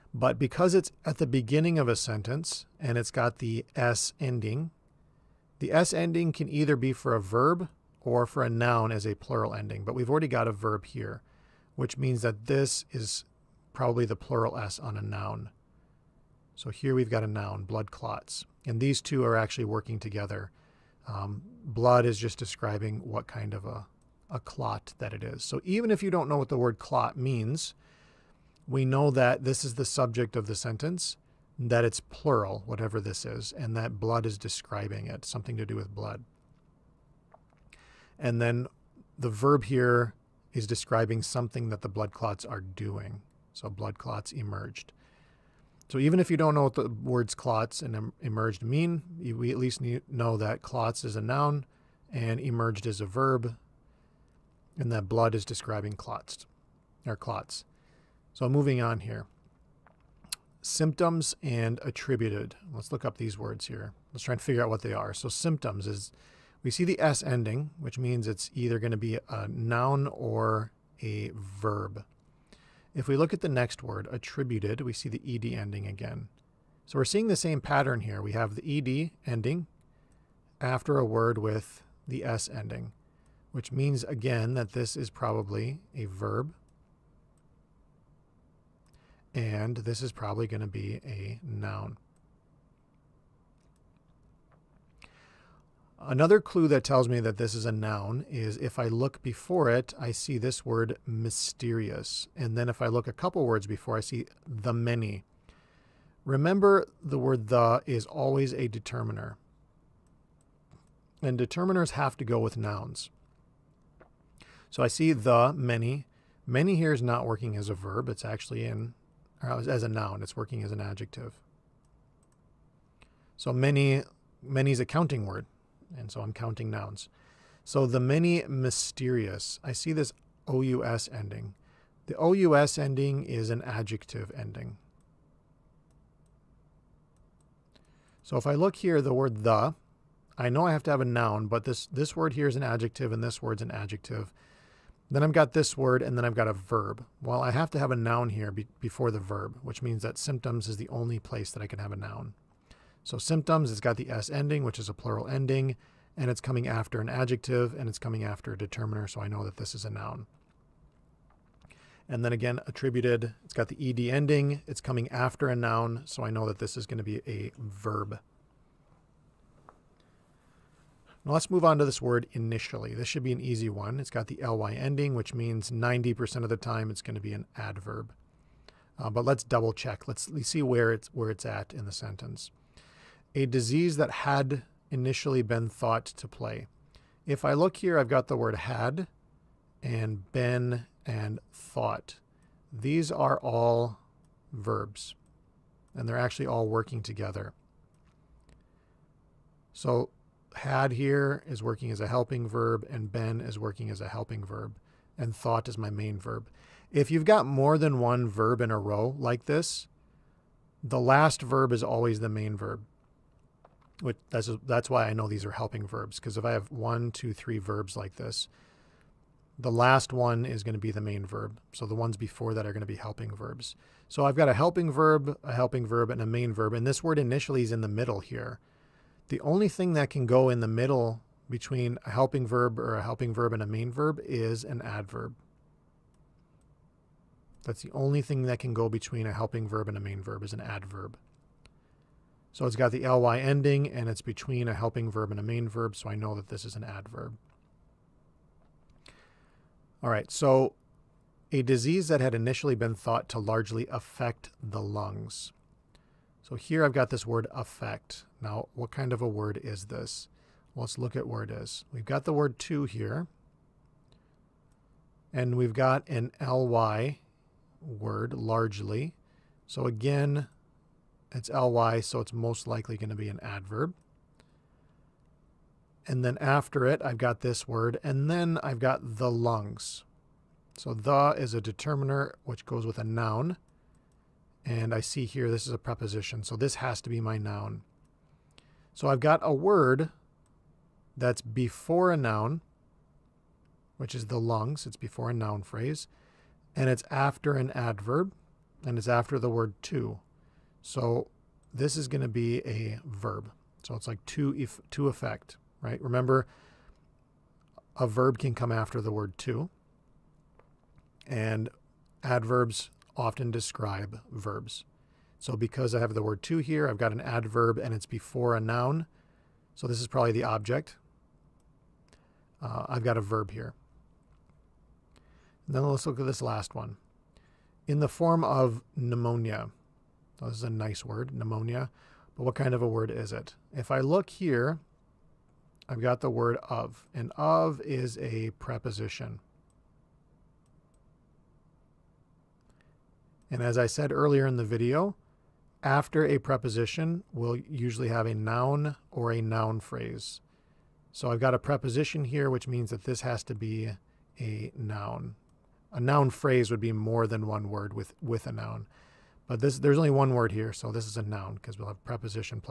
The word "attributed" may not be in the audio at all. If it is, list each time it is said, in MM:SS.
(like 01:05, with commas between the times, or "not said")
01:01, 01:14, 02:42.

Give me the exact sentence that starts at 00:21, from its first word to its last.
Um, blood is just describing what kind of a, a clot that it is.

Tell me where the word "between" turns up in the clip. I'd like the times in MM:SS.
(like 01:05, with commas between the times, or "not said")
03:51, 03:58, 04:04.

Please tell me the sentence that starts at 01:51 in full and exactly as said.
And determiners have to go with nouns.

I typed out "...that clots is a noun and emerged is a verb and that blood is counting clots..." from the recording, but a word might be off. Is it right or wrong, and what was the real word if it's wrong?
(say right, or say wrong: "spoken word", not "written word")
wrong: "describing", not "counting".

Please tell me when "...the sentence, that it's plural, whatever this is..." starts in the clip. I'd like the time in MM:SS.
00:30.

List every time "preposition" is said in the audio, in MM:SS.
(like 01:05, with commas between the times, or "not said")
04:45, 05:38, 05:46, 05:51, 06:02.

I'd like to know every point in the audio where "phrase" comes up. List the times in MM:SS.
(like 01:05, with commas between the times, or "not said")
04:55, 05:49, 05:56.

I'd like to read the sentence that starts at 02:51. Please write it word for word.
Now let's move on to this word initially.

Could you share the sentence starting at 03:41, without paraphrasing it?
So the ones before that are going to be helping verbs.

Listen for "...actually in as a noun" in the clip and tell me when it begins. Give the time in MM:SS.
01:58.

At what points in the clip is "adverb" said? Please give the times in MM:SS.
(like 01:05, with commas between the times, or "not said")
02:57, 03:54, 04:00, 04:06, 04:33, 04:57, 05:12, 05:17.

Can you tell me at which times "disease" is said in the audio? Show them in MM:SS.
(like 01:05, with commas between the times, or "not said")
03:03, 04:11.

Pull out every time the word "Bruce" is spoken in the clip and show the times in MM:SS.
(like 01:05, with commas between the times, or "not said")
not said.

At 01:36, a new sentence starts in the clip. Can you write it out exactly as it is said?
Another clue that tells me that this is a noun is if I look before it, I see this word mysterious.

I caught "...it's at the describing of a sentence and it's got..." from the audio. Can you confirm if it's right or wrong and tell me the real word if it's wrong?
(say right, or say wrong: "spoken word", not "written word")
wrong: "beginning", not "describing".